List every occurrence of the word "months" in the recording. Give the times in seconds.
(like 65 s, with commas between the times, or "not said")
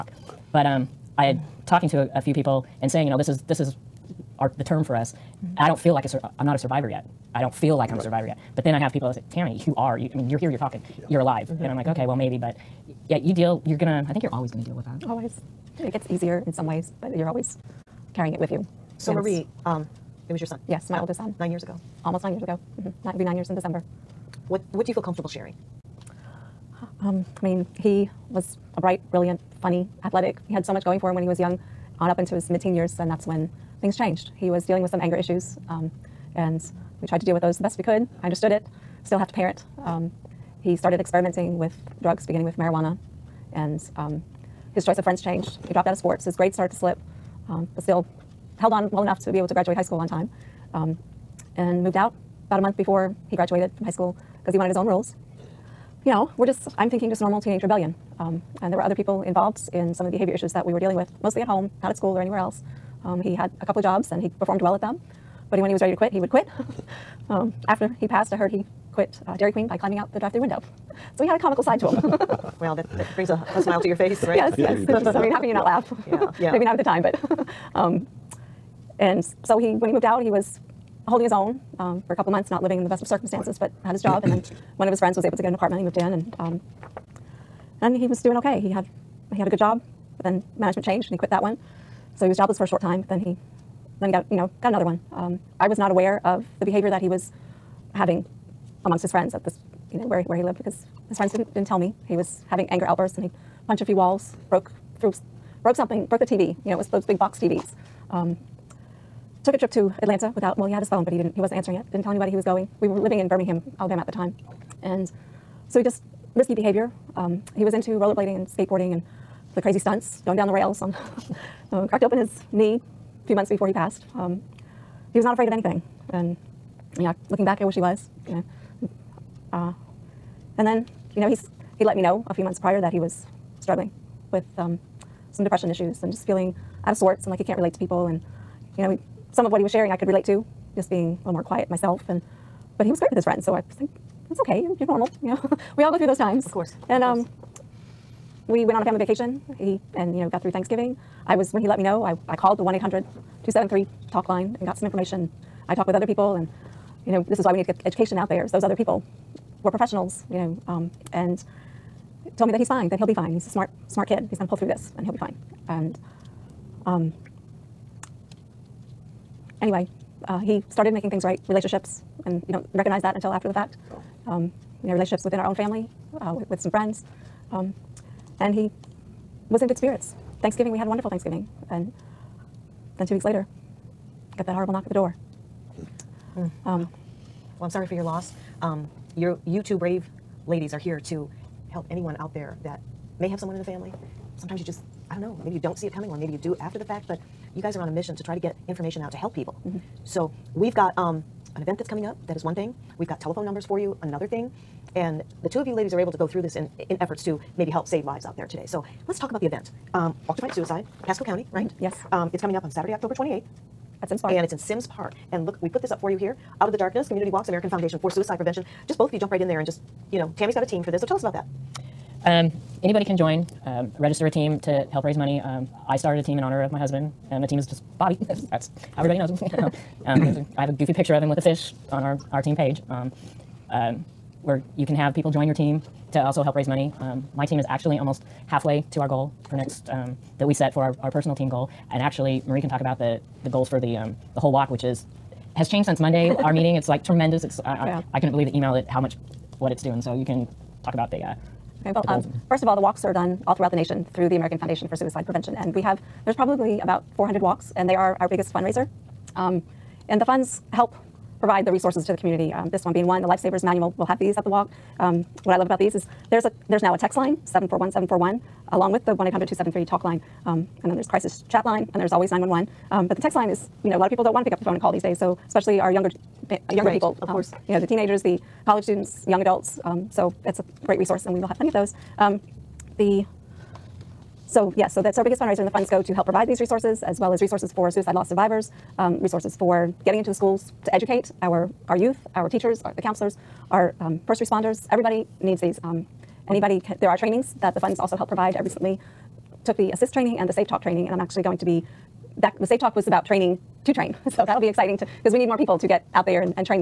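52 s, 82 s, 123 s, 132 s.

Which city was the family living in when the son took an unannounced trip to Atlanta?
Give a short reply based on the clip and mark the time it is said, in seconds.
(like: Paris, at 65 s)
Birmingham, Alabama, at 113 s.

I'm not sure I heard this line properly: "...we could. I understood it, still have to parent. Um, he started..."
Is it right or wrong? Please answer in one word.
right.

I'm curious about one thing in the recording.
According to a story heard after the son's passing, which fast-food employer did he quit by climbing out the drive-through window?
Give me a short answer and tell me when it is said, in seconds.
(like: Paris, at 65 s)
Dairy Queen, at 69 s.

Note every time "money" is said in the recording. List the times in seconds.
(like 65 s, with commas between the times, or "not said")
225 s, 236 s.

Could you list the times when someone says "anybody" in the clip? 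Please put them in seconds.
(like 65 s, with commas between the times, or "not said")
112 s, 222 s, 296 s.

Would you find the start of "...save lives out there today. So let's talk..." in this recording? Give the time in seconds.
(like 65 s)
207 s.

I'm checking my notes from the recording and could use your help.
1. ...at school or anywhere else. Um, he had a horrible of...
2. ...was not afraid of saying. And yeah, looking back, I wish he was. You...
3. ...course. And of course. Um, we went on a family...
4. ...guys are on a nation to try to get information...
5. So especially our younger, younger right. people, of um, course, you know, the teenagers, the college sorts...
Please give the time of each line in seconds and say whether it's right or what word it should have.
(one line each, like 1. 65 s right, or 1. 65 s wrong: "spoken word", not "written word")
1. 61 s wrong: "couple", not "horrible"
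2. 125 s wrong: "anything", not "saying"
3. 146 s right
4. 197 s wrong: "mission", not "nation"
5. 275 s wrong: "students", not "sorts".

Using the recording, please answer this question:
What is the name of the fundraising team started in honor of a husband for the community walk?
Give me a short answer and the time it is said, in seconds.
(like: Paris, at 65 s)
Bobby, at 227 s.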